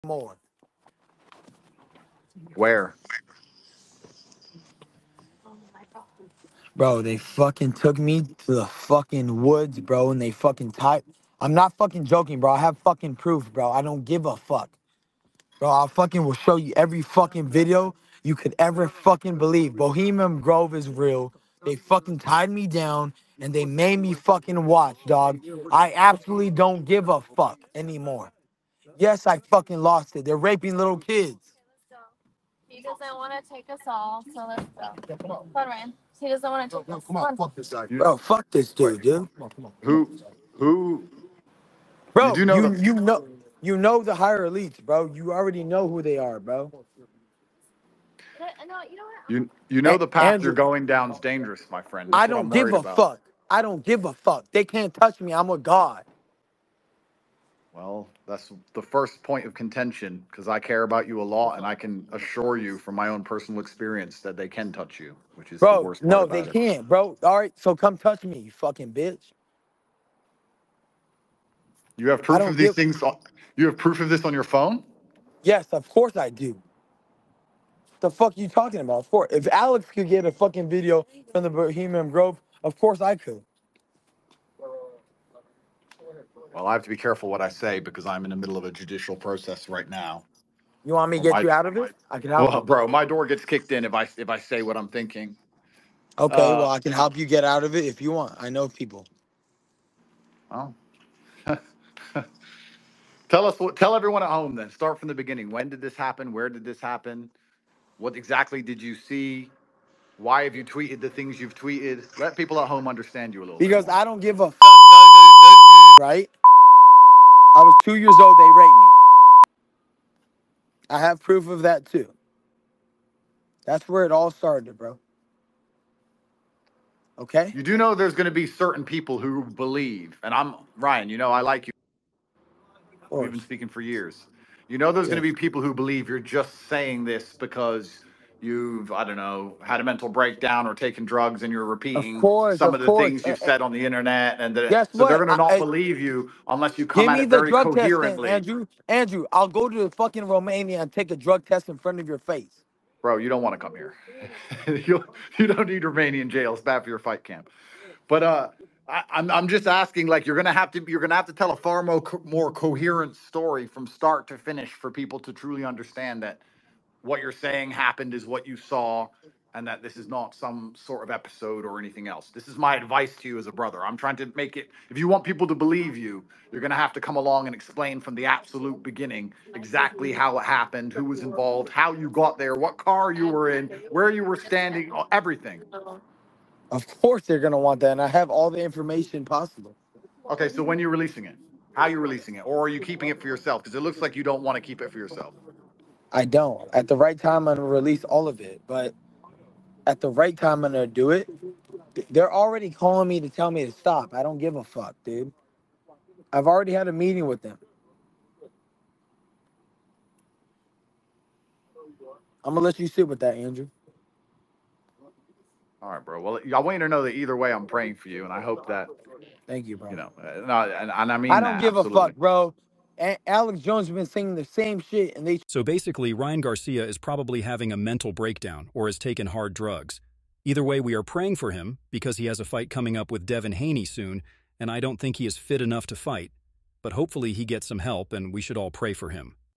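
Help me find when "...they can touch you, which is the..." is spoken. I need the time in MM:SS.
01:04.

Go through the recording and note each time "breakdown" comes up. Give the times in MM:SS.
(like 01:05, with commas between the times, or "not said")
02:20, 03:48.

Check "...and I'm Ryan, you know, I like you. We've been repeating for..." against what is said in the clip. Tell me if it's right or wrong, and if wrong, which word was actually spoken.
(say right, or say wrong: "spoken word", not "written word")
wrong: "speaking", not "repeating".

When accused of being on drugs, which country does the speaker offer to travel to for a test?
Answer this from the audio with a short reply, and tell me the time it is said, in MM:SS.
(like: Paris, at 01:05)
Romania, at 02:30.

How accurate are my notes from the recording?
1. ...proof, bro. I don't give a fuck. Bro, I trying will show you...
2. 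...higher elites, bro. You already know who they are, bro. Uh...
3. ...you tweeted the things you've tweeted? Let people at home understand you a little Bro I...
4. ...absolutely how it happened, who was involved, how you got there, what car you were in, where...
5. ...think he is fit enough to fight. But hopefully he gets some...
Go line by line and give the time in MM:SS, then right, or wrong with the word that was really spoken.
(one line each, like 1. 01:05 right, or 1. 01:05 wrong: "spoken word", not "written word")
1. 00:13 wrong: "fucking", not "trying"
2. 00:44 right
3. 01:50 wrong: "Because", not "Bro"
4. 02:59 wrong: "exactly", not "absolutely"
5. 03:54 right.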